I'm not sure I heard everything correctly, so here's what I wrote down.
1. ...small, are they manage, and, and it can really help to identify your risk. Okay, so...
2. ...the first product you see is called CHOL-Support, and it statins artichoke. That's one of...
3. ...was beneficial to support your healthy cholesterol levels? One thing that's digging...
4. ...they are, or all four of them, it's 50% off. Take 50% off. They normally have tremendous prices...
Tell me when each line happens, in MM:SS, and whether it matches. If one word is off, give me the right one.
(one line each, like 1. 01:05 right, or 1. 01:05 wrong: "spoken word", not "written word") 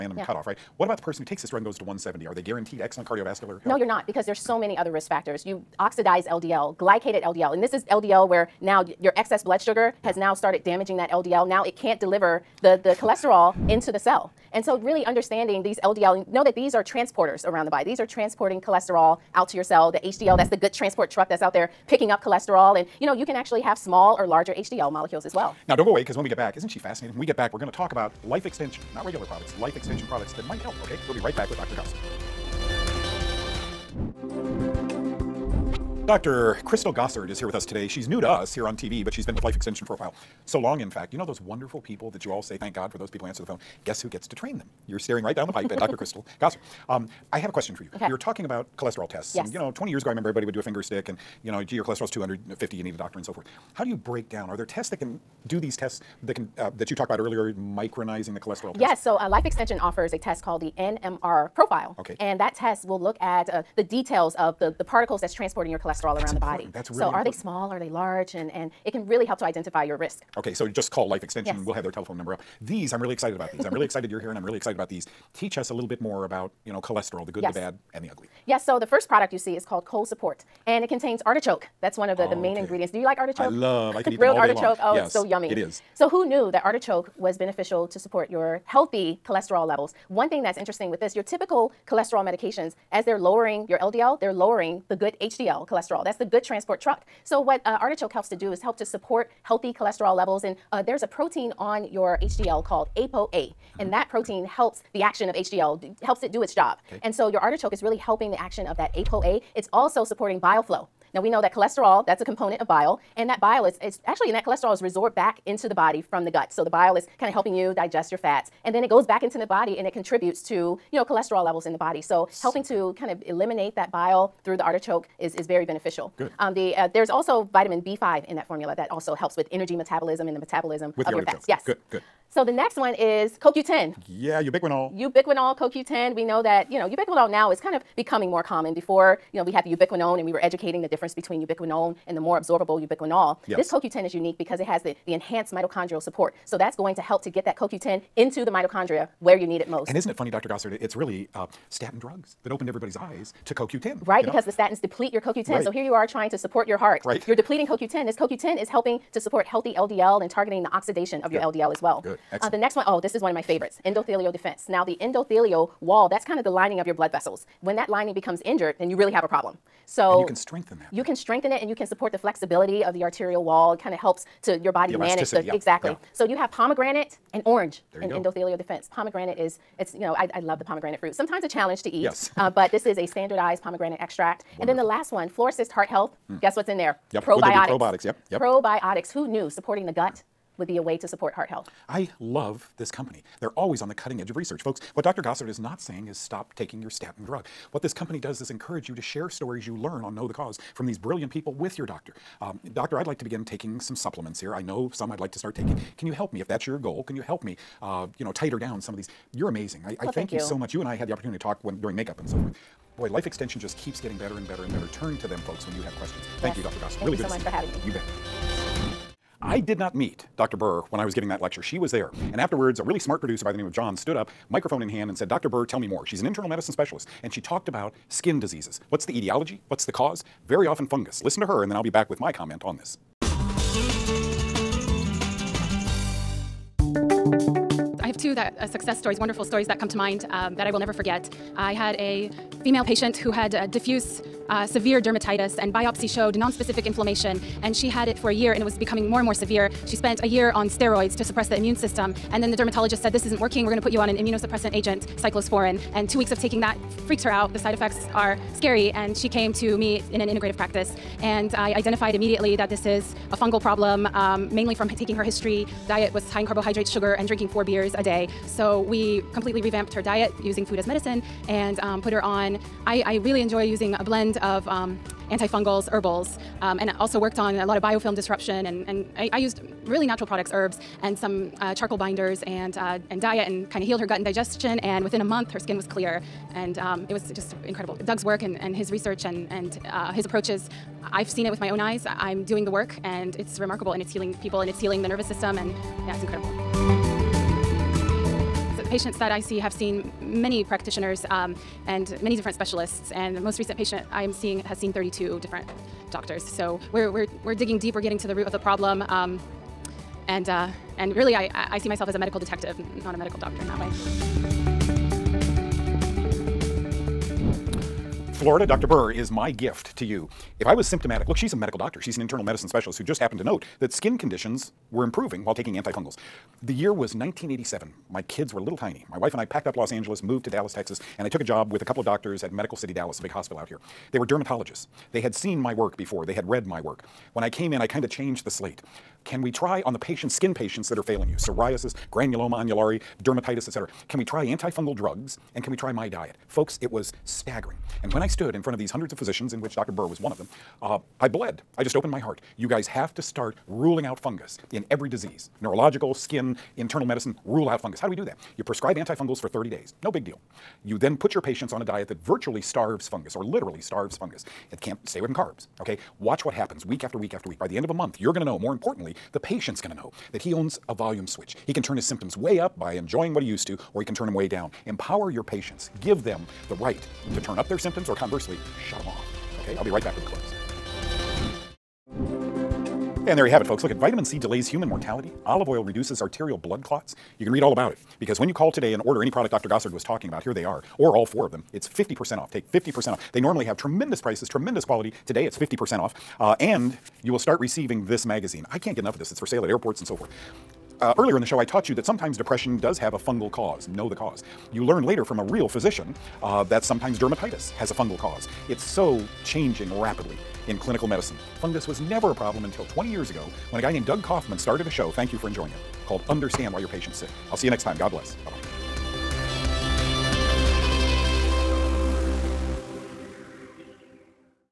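1. 01:07 wrong: "large", not "manage"
2. 01:18 wrong: "contains", not "statins"
3. 01:27 wrong: "interesting", not "digging"
4. 06:30 right.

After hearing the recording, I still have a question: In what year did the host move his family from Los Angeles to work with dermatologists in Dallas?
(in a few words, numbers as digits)
1987.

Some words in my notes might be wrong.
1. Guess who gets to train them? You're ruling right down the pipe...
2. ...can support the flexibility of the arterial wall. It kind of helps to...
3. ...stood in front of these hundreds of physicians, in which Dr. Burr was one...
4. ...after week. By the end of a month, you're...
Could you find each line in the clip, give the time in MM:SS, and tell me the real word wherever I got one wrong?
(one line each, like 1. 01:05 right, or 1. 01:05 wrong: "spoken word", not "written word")
1. 00:43 wrong: "staring", not "ruling"
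2. 02:51 right
3. 05:48 right
4. 06:07 right.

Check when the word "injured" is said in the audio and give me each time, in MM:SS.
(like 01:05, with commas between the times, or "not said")
02:48.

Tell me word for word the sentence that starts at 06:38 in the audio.
I can't get enough of this.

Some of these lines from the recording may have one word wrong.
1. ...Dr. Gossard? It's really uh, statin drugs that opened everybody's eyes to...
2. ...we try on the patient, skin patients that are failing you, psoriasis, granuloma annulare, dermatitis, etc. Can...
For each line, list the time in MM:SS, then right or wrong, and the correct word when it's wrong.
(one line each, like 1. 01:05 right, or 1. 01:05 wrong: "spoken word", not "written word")
1. 02:30 right
2. 05:39 right.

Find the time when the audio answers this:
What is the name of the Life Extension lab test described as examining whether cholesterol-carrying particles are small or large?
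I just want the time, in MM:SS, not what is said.
01:00.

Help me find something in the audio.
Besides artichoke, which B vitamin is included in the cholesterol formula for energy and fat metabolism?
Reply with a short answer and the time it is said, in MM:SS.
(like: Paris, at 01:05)
vitamin B5, at 02:07.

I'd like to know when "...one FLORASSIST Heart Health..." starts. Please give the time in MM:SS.
03:05.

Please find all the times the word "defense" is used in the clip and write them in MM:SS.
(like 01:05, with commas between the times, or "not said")
02:44, 02:58.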